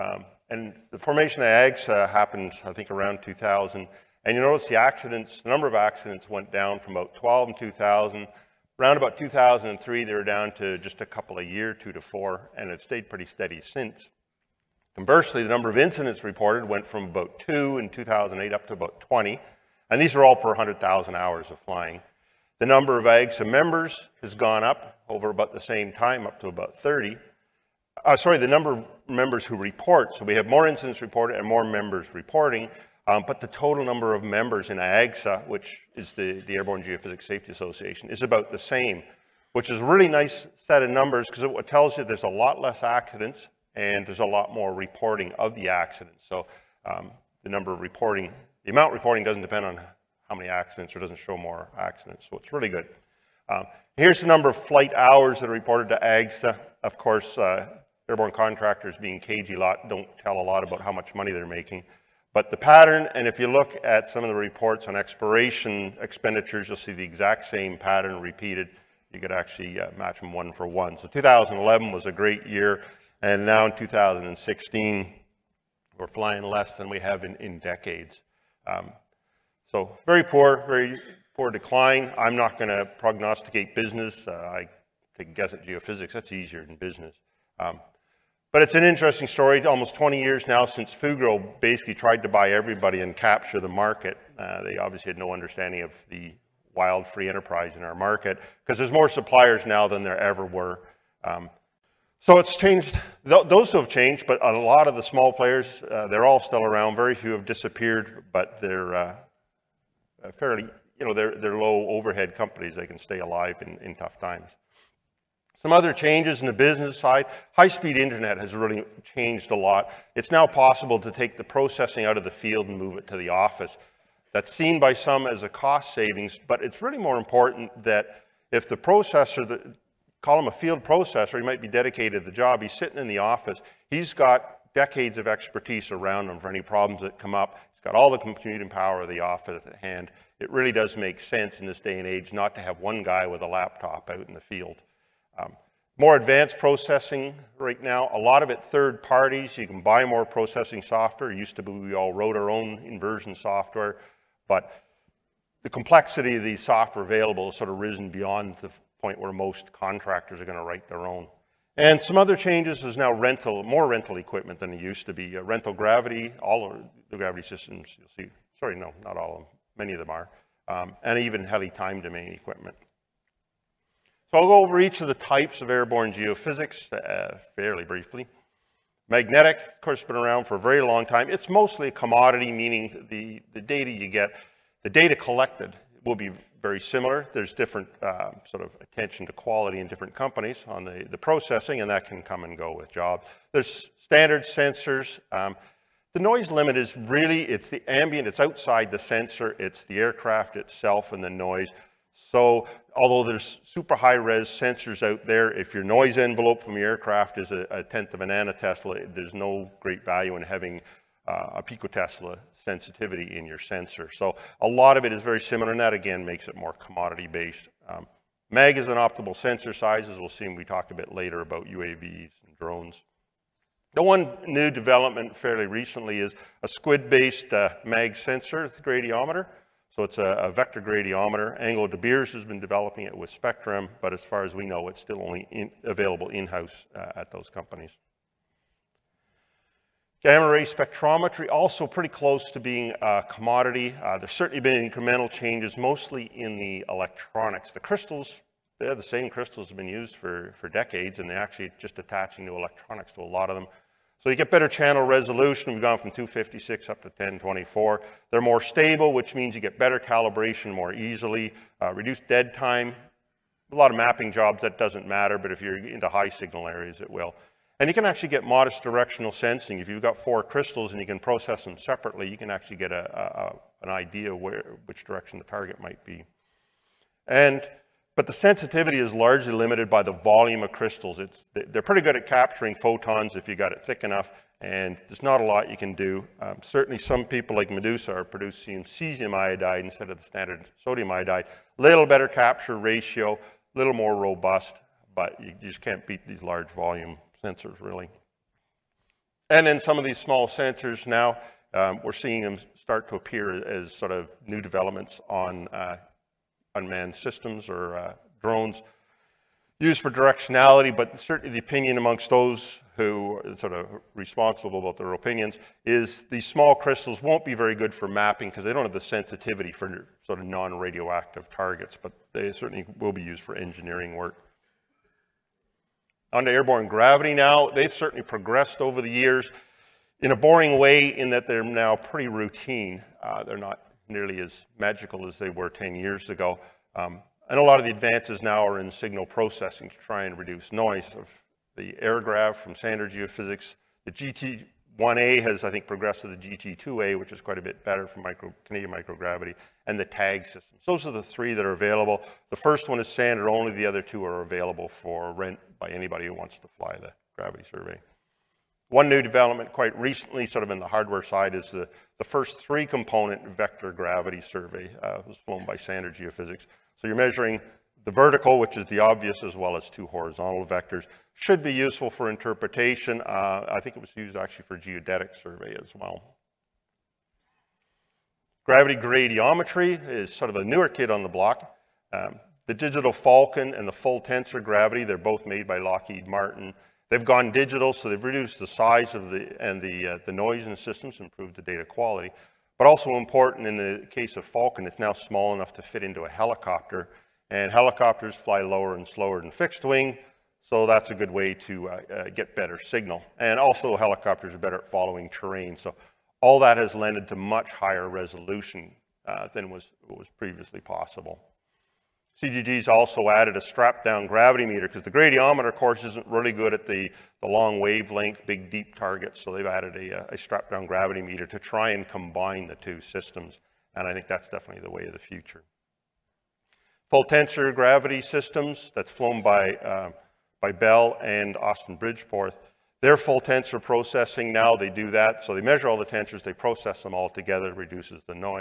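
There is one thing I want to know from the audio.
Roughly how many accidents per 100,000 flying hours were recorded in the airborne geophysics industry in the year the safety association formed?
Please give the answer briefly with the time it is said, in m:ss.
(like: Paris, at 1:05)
12, at 0:06.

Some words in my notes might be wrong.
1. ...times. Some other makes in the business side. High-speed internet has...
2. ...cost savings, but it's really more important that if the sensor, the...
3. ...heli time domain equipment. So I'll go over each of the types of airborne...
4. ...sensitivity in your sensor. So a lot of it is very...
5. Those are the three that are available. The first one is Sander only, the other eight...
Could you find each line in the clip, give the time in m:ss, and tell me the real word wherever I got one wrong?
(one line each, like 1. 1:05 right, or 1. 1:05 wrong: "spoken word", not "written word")
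1. 1:54 wrong: "changes", not "makes"
2. 2:05 wrong: "processor", not "sensor"
3. 2:51 right
4. 3:32 right
5. 5:50 wrong: "two", not "eight".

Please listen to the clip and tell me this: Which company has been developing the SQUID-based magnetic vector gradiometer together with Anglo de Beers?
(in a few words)
Spectrum.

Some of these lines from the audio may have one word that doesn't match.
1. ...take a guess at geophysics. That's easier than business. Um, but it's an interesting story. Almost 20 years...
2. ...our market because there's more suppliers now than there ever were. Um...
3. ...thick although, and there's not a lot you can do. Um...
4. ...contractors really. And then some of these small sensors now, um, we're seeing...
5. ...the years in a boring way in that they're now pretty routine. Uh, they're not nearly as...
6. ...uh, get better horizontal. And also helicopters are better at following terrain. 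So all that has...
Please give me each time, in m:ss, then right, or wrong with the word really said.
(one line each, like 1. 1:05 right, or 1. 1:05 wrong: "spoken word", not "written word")
1. 1:25 right
2. 1:37 right
3. 4:43 wrong: "enough", not "although"
4. 4:57 wrong: "sensors", not "contractors"
5. 5:29 right
6. 6:42 wrong: "signal", not "horizontal".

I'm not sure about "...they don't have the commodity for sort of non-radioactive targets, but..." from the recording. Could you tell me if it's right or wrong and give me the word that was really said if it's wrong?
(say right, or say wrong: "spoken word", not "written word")
wrong: "sensitivity", not "commodity".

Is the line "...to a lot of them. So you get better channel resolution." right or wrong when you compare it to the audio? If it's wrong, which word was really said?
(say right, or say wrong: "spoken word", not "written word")
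right.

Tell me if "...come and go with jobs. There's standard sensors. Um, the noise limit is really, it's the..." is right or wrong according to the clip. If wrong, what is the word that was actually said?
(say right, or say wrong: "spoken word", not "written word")
right.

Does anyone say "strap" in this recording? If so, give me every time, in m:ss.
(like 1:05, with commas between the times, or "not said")
6:53, 7:00.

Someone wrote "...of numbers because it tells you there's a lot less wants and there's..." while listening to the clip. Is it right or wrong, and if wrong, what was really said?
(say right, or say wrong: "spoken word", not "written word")
wrong: "accidents", not "wants".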